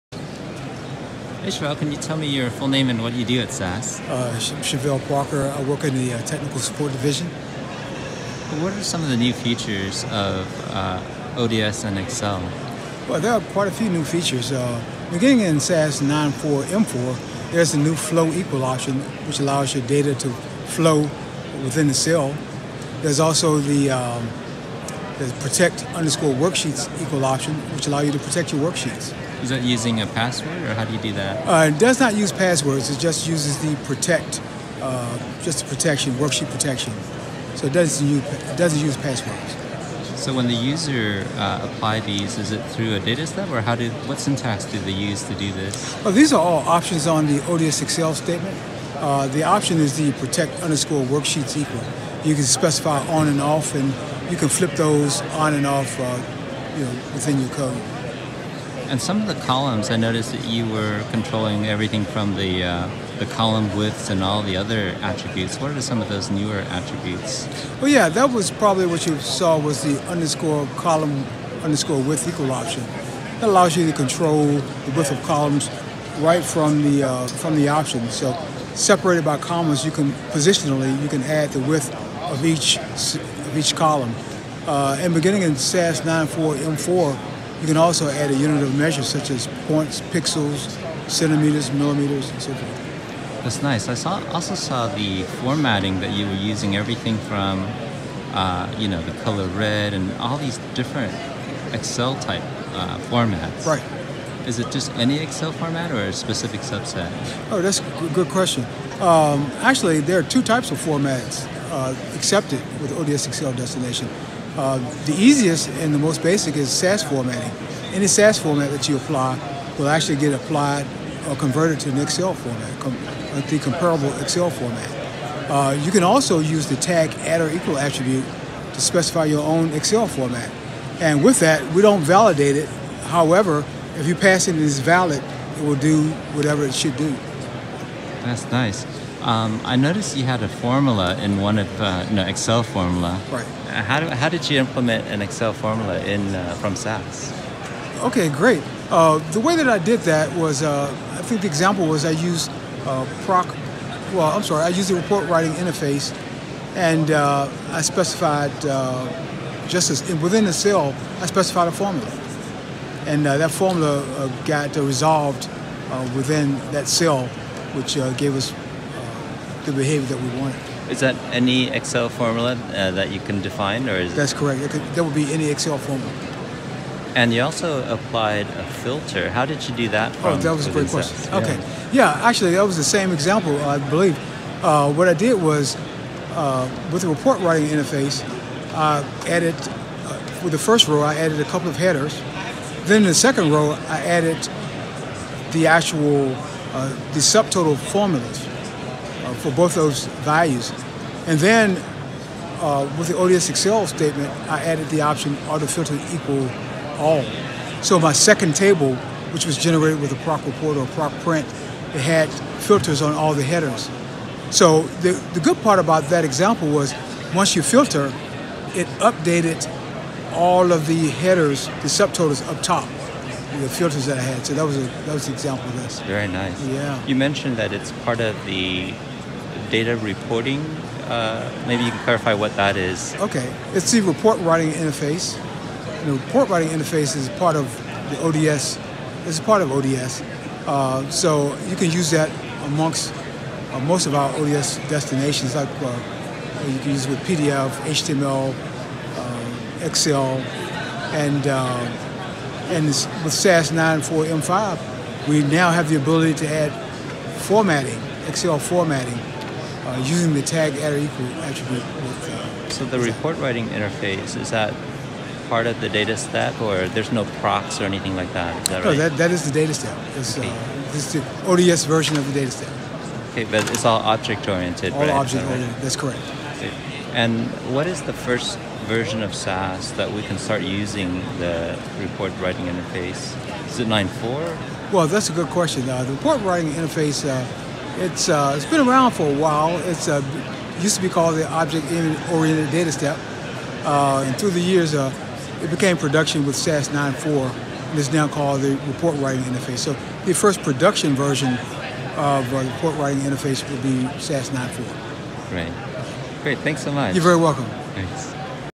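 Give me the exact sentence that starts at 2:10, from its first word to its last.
And with that, we don't validate it.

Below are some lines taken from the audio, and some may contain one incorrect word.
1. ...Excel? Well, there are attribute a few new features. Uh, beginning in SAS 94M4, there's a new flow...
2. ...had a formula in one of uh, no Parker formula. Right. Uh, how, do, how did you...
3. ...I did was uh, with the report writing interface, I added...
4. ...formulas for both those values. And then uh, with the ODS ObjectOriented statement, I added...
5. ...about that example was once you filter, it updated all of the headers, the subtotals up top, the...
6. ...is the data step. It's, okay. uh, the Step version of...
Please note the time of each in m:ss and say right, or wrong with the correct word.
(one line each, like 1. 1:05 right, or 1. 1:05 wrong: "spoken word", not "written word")
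1. 0:11 wrong: "quite", not "attribute"
2. 2:20 wrong: "Excel", not "Parker"
3. 3:05 right
4. 3:17 wrong: "Excel", not "ObjectOriented"
5. 3:35 right
6. 4:29 wrong: "ODS", not "Step".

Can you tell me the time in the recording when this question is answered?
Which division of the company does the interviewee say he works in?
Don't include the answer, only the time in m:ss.
0:06.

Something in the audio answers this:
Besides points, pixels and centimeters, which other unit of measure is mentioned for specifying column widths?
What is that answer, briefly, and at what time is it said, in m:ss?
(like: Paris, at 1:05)
millimeters, at 1:31.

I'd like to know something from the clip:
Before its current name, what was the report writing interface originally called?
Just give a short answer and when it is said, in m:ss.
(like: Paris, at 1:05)
Object-Oriented Data Step, at 4:51.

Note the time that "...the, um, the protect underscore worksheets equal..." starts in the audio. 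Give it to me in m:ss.
0:23.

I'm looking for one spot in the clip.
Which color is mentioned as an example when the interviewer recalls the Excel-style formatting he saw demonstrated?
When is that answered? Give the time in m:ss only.
1:39.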